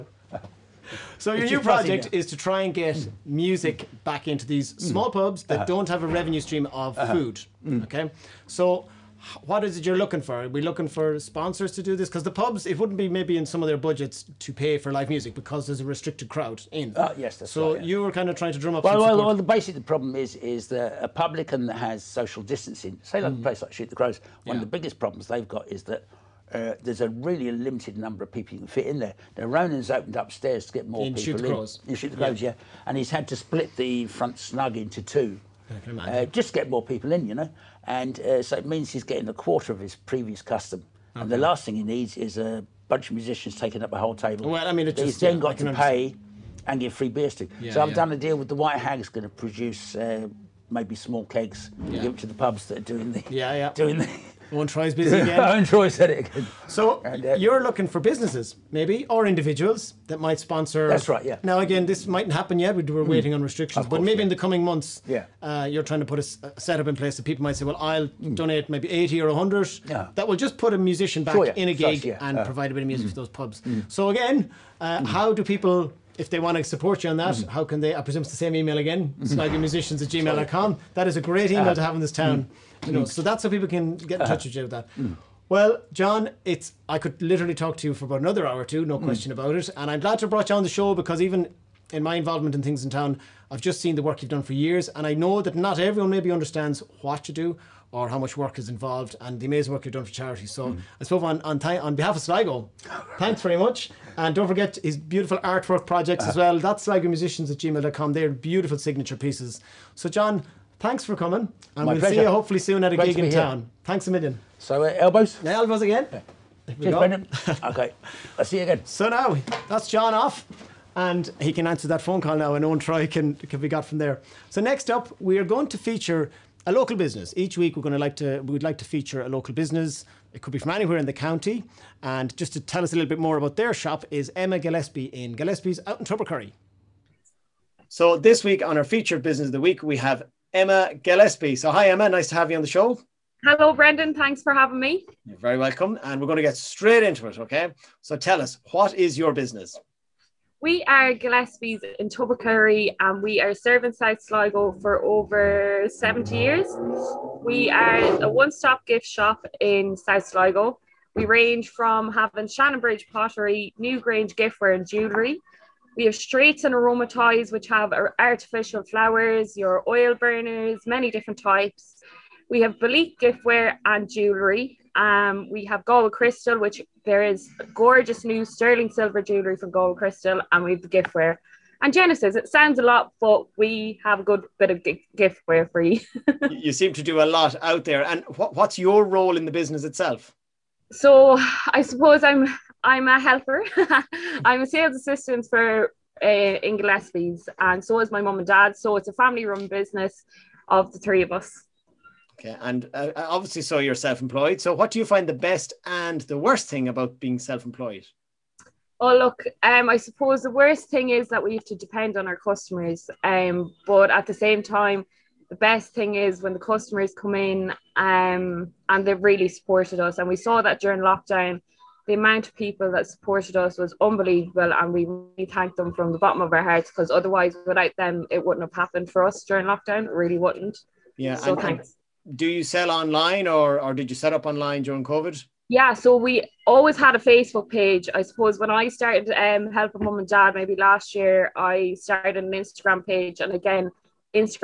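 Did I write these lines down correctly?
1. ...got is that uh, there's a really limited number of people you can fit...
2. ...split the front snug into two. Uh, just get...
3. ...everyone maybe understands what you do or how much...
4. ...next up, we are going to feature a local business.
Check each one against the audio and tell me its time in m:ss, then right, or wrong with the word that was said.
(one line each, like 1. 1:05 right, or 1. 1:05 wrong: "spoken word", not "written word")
1. 0:25 right
2. 0:33 right
3. 1:35 right
4. 2:04 right.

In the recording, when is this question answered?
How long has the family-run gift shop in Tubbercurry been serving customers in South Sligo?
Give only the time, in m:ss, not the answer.
2:35.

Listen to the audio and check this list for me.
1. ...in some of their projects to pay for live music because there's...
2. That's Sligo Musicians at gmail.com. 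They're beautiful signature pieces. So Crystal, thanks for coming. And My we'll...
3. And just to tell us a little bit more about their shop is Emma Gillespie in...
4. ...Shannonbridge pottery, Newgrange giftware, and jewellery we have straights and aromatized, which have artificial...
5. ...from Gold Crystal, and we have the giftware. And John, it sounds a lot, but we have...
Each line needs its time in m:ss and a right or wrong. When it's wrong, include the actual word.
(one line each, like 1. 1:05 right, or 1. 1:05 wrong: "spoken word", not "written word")
1. 0:13 wrong: "budgets", not "projects"
2. 1:46 wrong: "John", not "Crystal"
3. 2:12 right
4. 2:42 right
5. 2:59 wrong: "Genesis", not "John".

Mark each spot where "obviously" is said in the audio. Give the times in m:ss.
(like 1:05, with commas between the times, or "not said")
3:23.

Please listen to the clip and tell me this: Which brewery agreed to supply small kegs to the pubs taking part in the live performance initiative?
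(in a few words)
White Hag.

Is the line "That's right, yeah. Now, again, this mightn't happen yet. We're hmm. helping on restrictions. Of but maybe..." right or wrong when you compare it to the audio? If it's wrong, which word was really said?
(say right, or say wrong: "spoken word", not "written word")
wrong: "waiting", not "helping".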